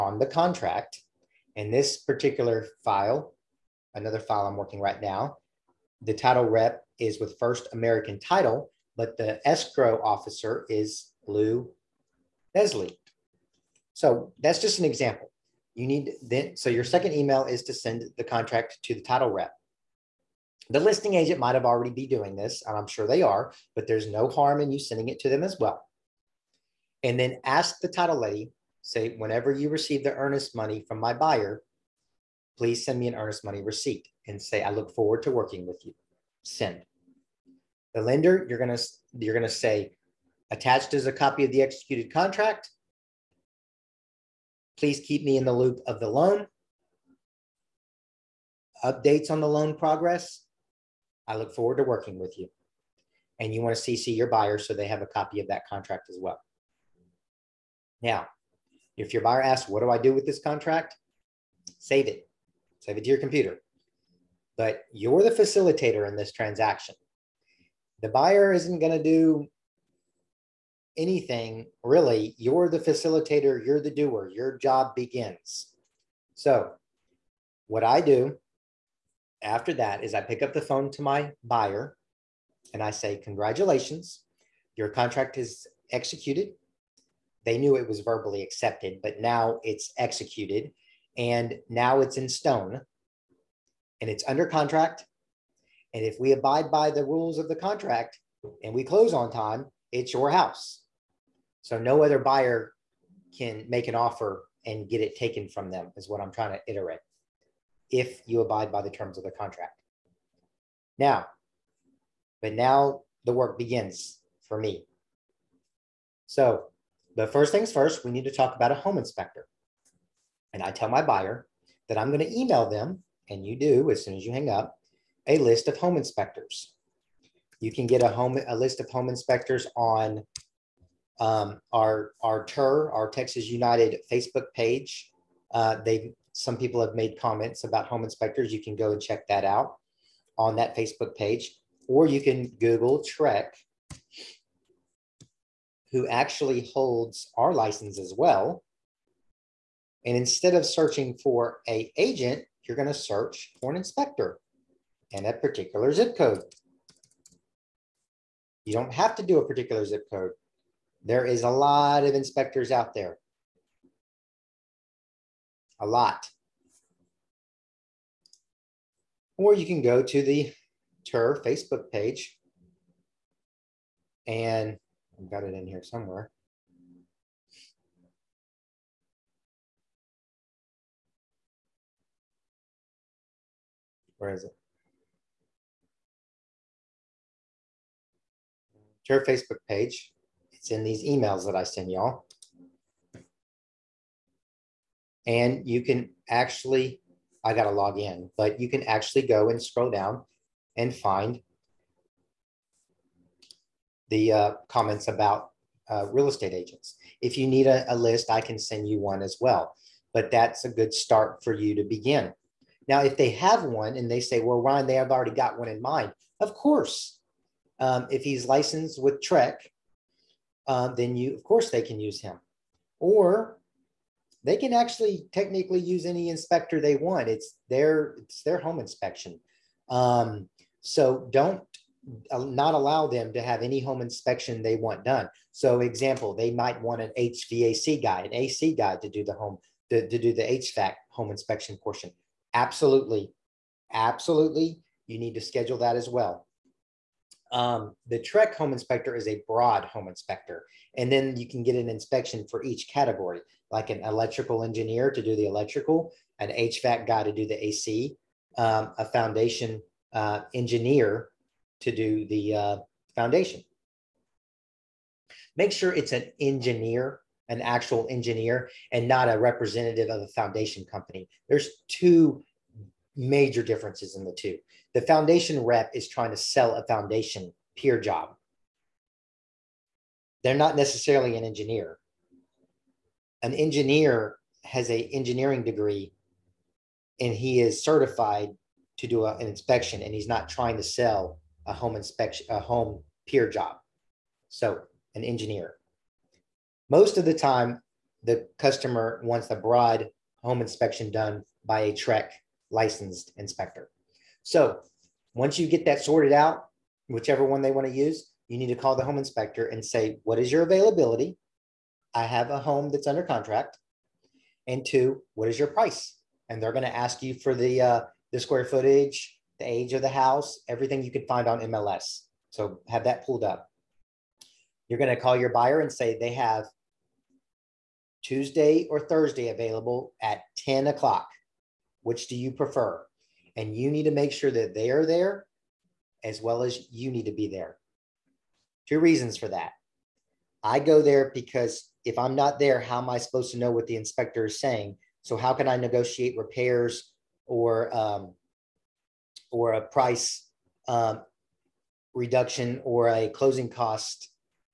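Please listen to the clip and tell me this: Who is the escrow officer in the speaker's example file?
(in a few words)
Lou Leslie.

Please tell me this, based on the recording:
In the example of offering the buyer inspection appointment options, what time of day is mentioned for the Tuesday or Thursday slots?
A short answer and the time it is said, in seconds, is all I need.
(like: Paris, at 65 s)
10 o'clock, at 330 s.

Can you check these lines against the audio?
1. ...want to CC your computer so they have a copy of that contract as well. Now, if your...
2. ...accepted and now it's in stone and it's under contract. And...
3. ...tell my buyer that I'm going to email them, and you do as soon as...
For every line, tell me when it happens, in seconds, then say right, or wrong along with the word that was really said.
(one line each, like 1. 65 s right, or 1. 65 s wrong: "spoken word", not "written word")
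1. 53 s wrong: "buyer", not "computer"
2. 89 s wrong: "executed", not "accepted"
3. 120 s right.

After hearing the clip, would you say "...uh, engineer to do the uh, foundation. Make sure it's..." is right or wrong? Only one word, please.
right.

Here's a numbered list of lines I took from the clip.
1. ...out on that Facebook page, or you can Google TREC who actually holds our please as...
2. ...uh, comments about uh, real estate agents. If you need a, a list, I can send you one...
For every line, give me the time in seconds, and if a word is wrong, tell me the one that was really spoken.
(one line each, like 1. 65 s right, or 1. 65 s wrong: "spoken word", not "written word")
1. 139 s wrong: "license", not "please"
2. 204 s right.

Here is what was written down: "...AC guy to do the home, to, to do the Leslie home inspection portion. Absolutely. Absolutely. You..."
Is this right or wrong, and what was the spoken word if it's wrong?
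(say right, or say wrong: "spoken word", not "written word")
wrong: "HVAC", not "Leslie".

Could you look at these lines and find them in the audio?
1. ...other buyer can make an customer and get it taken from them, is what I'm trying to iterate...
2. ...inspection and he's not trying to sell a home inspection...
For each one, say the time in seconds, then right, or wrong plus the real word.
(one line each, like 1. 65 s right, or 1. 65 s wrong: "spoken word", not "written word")
1. 102 s wrong: "offer", not "customer"
2. 289 s right.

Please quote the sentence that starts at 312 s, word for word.
I have a home that's under contract.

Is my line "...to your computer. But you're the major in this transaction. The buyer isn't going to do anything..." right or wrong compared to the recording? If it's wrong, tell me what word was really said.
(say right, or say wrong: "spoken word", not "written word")
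wrong: "facilitator", not "major".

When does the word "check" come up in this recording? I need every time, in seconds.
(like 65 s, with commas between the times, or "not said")
139 s.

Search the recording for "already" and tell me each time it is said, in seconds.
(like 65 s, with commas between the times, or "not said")
21 s, 215 s.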